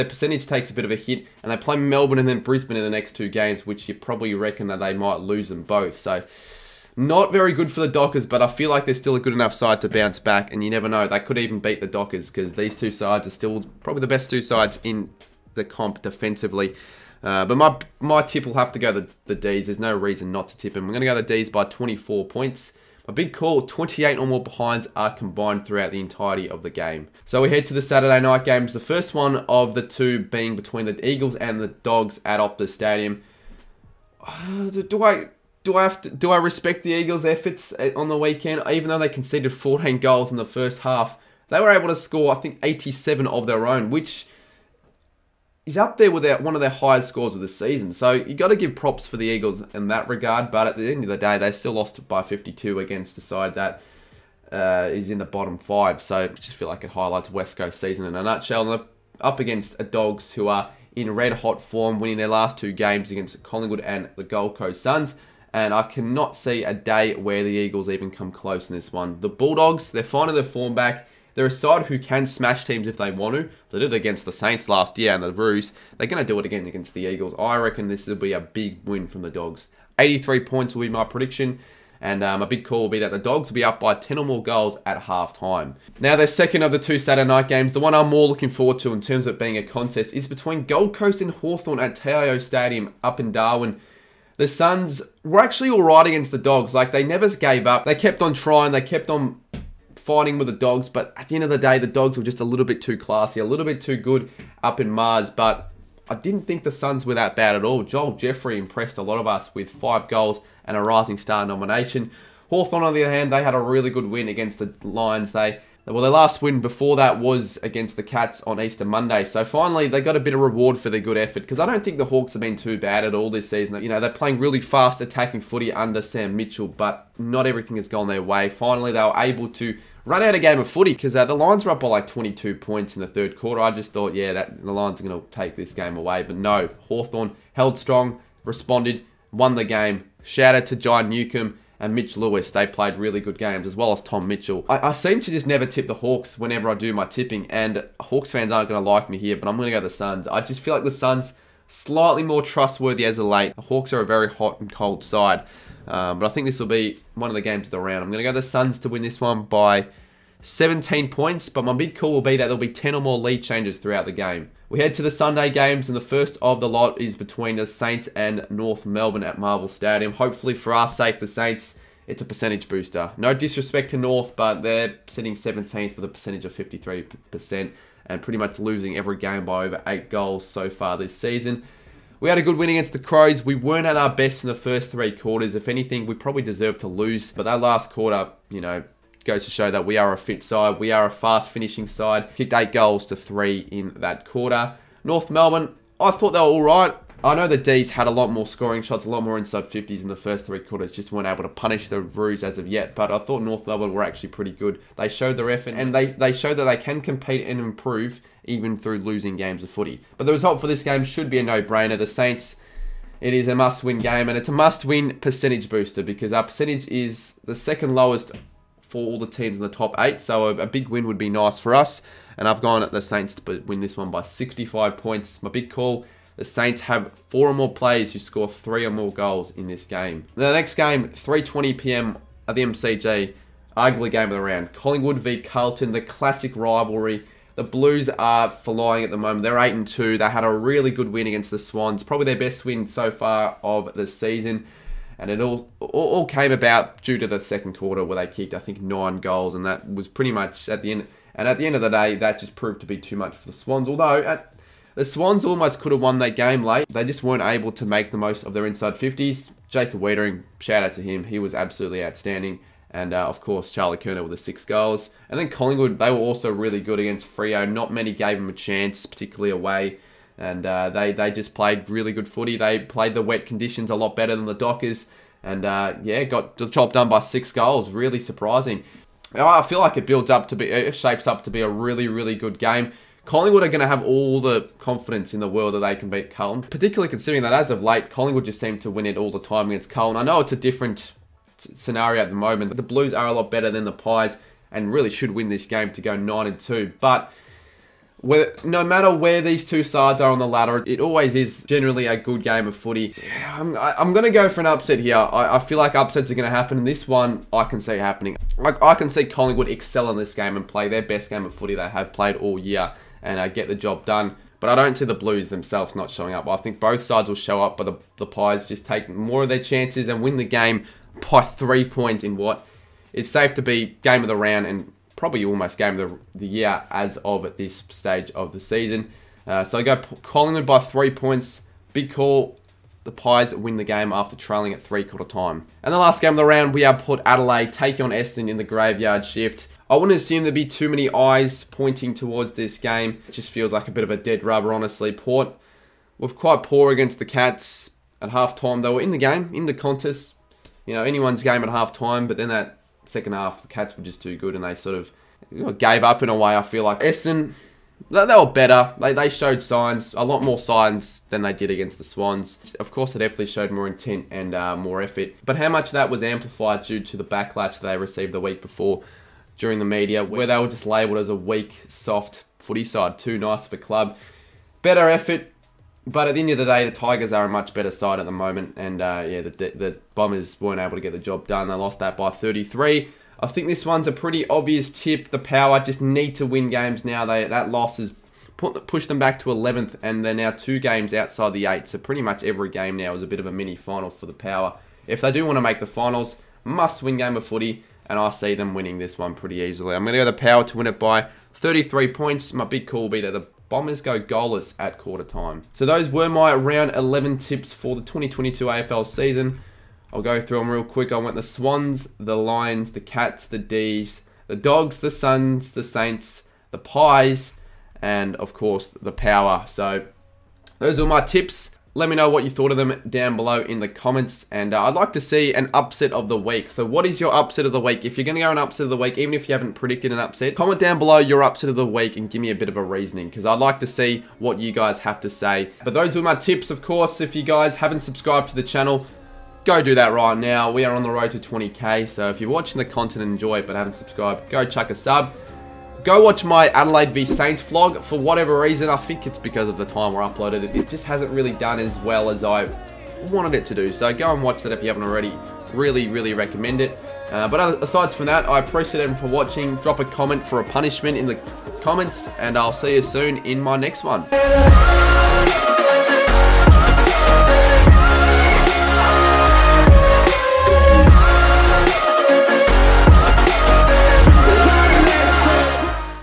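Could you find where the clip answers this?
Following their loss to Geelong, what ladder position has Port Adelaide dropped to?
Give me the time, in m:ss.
6:29.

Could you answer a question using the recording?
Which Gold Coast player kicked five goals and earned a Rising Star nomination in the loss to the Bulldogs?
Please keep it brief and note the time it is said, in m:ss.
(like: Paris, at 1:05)
Joel Jeffrey, at 1:47.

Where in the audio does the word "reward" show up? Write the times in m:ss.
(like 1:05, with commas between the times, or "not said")
2:00.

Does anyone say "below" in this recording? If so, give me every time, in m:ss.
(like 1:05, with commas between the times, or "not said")
7:03, 7:10.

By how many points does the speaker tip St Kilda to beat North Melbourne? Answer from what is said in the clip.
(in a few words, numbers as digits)
65 points.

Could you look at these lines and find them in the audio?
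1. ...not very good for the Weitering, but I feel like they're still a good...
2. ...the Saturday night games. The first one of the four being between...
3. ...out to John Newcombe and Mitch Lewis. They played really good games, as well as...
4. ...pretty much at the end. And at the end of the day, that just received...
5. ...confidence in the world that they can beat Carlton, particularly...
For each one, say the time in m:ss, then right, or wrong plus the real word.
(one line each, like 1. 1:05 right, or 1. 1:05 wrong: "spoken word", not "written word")
1. 0:06 wrong: "Dockers", not "Weitering"
2. 0:27 wrong: "two", not "four"
3. 2:20 right
4. 4:10 wrong: "proved", not "received"
5. 4:44 right.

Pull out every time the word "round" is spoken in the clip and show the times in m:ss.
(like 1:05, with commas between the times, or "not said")
2:37, 3:54, 5:24, 5:36, 6:46.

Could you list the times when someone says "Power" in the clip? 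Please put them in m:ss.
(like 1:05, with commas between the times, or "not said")
6:25, 6:34, 6:40, 6:59.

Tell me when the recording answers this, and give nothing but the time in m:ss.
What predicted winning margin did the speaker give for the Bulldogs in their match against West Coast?
1:19.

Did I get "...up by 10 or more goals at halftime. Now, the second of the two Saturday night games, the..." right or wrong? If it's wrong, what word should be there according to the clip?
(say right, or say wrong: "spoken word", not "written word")
right.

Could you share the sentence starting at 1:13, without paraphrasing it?
They did it against the Saints last year and the Roos.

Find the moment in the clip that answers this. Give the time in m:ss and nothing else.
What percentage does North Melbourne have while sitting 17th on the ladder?
2:56.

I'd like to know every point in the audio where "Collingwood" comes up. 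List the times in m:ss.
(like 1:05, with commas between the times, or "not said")
1:03, 3:54, 4:25, 4:43, 4:48, 5:09, 5:30.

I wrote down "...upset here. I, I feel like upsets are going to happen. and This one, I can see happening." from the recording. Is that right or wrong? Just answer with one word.
right.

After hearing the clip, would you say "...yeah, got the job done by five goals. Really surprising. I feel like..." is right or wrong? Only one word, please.
wrong.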